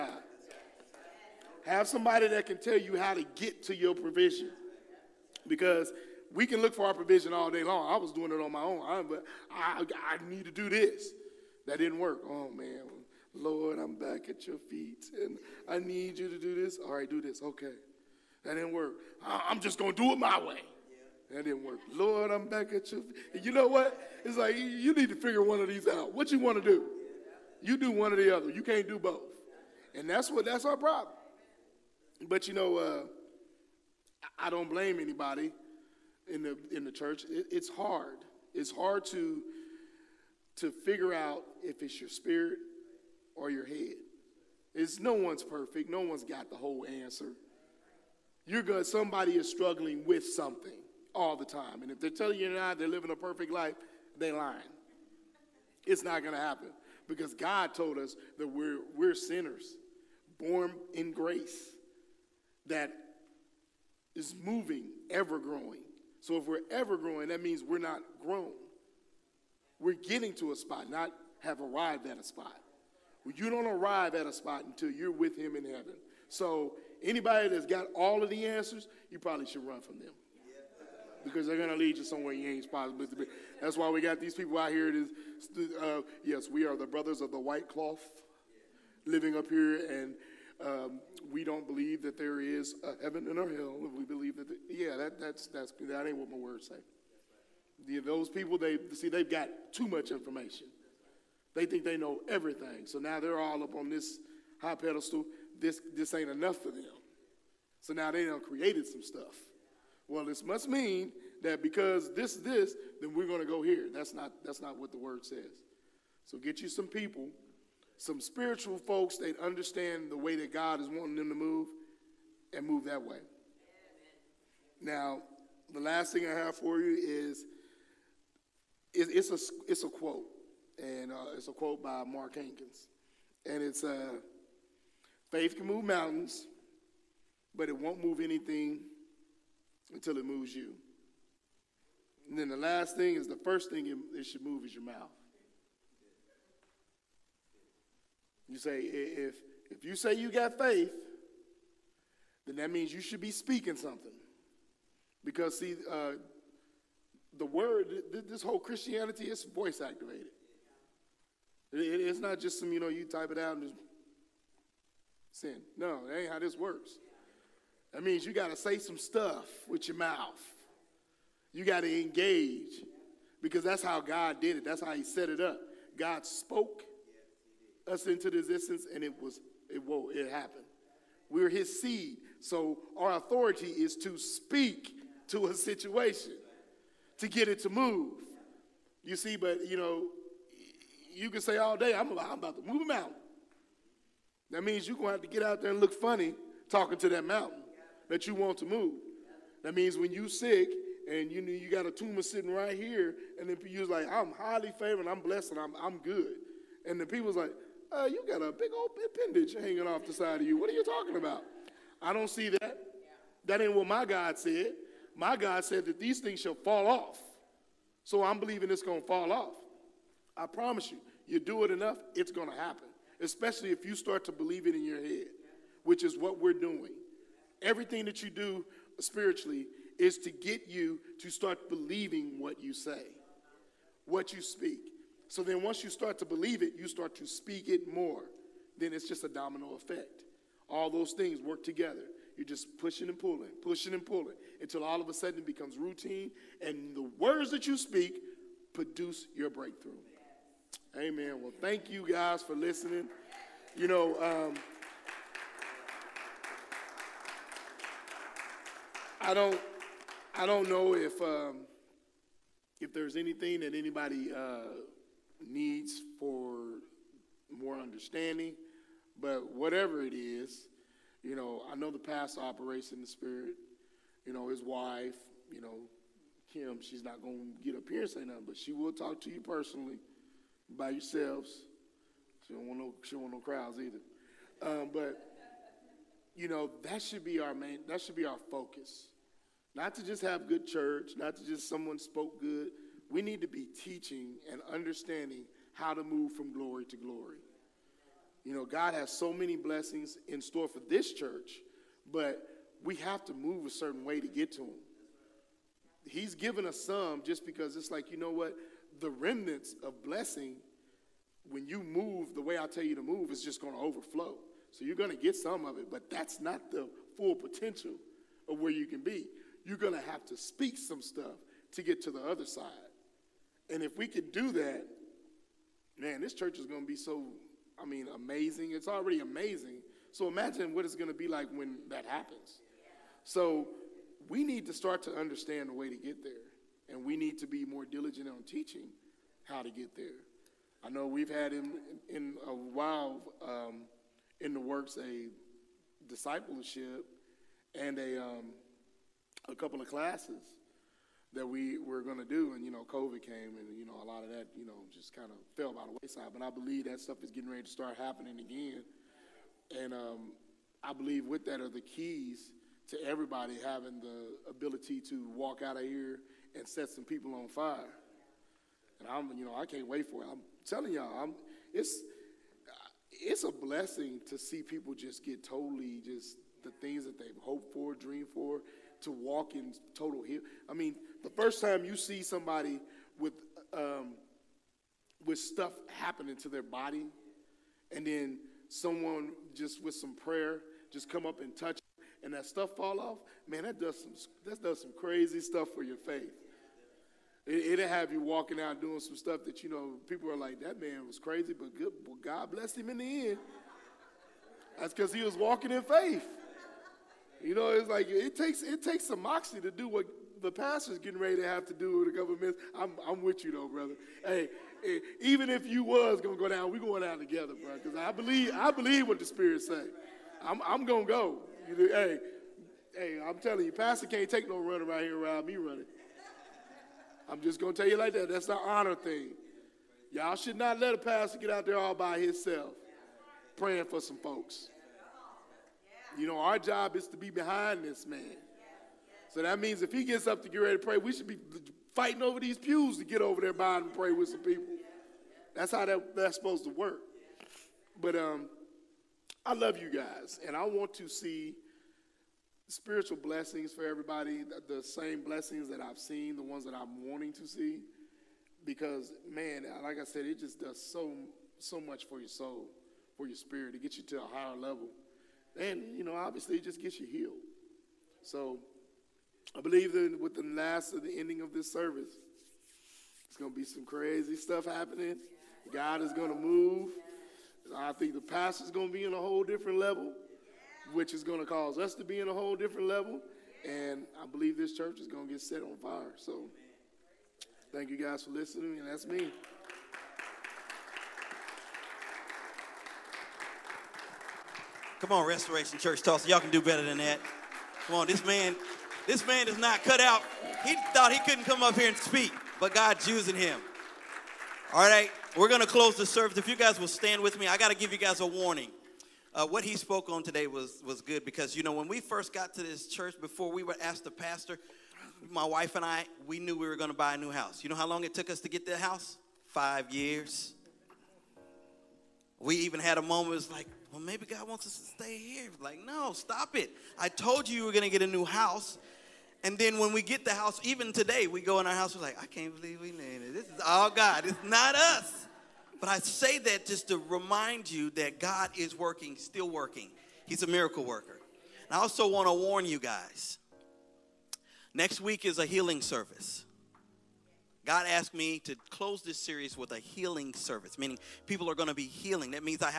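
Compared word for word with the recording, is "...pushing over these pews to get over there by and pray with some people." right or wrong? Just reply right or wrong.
wrong.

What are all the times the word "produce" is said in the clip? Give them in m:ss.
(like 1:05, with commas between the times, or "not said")
4:08.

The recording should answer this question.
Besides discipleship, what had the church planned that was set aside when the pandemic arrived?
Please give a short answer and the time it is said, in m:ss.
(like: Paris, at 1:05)
a couple of classes, at 5:49.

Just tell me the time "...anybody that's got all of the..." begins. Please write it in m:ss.
1:17.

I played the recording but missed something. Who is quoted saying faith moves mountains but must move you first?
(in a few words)
Mark Hankins.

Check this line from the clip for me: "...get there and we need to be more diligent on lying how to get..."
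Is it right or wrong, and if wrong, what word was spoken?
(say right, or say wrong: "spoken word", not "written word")
wrong: "teaching", not "lying".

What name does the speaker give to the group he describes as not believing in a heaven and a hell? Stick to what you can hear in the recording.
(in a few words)
brothers of the white cloth.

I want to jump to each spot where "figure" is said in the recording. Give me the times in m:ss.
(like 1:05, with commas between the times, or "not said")
0:25, 0:40.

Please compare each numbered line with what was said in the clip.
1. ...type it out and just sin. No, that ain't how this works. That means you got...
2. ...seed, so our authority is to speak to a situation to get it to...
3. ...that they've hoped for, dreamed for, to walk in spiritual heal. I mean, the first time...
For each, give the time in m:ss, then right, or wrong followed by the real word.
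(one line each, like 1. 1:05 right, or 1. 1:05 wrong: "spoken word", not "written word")
1. 2:43 right
2. 3:01 right
3. 6:17 wrong: "total", not "spiritual".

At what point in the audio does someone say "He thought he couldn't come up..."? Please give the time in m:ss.
8:20.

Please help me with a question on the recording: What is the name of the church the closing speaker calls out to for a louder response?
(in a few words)
Restoration Church Tulsa.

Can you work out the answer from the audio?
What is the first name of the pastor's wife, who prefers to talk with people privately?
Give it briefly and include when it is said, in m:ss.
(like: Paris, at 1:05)
Kim, at 4:36.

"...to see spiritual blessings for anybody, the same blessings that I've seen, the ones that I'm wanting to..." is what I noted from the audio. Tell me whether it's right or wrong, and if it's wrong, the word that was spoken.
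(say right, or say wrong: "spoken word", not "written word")
wrong: "everybody", not "anybody".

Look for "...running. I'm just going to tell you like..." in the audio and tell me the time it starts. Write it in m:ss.
7:05.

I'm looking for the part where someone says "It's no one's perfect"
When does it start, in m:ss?
0:44.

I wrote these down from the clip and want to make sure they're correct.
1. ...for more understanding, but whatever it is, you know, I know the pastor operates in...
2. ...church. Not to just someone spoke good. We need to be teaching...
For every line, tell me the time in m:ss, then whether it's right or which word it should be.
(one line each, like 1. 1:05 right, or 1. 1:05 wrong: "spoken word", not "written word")
1. 4:26 right
2. 4:50 right.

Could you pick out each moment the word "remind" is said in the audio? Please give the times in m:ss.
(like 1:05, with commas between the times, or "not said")
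8:56.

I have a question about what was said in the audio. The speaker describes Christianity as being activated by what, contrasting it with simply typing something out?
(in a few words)
voice.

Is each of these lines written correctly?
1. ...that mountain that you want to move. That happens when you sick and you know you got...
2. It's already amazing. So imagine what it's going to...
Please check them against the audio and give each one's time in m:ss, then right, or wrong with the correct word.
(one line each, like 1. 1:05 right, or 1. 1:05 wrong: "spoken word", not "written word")
1. 3:17 wrong: "means", not "happens"
2. 5:28 right.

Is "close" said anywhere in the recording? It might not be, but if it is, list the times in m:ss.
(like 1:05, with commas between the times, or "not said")
8:25, 9:08.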